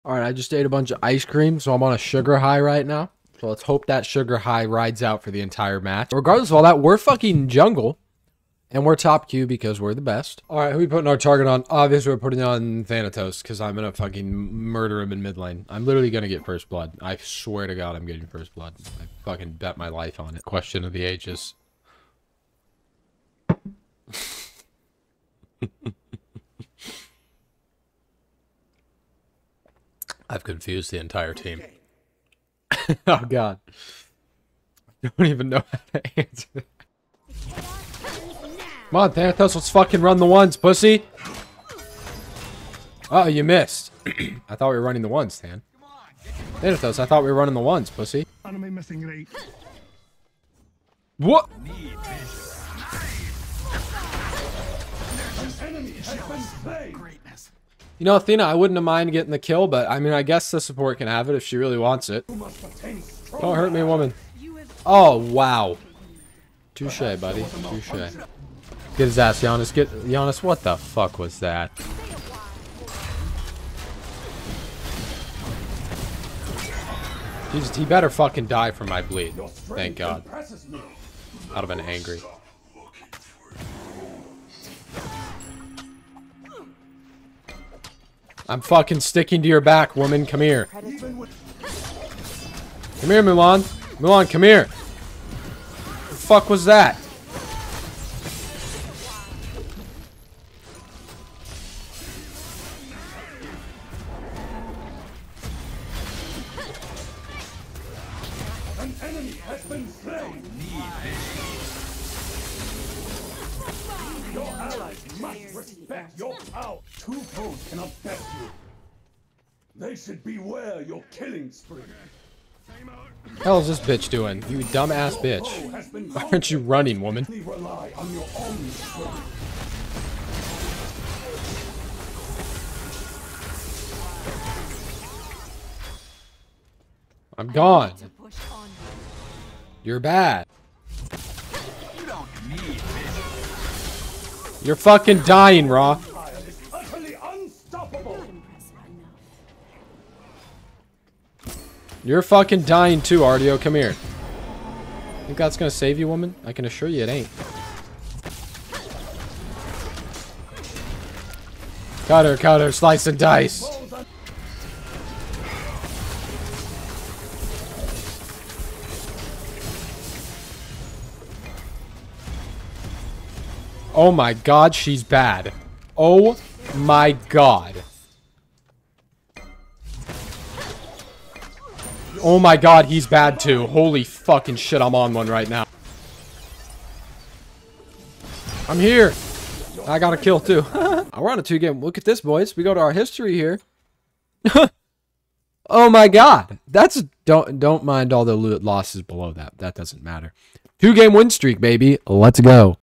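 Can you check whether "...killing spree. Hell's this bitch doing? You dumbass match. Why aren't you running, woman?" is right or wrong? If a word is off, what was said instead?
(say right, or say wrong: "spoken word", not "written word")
wrong: "bitch", not "match".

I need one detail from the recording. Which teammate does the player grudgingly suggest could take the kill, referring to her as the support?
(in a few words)
Athena.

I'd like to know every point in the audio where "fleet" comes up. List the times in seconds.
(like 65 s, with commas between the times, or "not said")
not said.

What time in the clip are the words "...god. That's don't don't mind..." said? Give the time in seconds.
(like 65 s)
196 s.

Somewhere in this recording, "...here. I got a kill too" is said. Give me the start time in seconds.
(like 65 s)
188 s.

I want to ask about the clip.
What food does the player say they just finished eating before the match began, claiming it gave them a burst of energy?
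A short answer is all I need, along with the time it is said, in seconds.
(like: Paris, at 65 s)
ice cream, at 1 s.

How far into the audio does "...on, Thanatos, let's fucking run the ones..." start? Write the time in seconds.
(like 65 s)
38 s.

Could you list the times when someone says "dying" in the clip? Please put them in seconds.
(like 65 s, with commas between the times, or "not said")
145 s, 152 s.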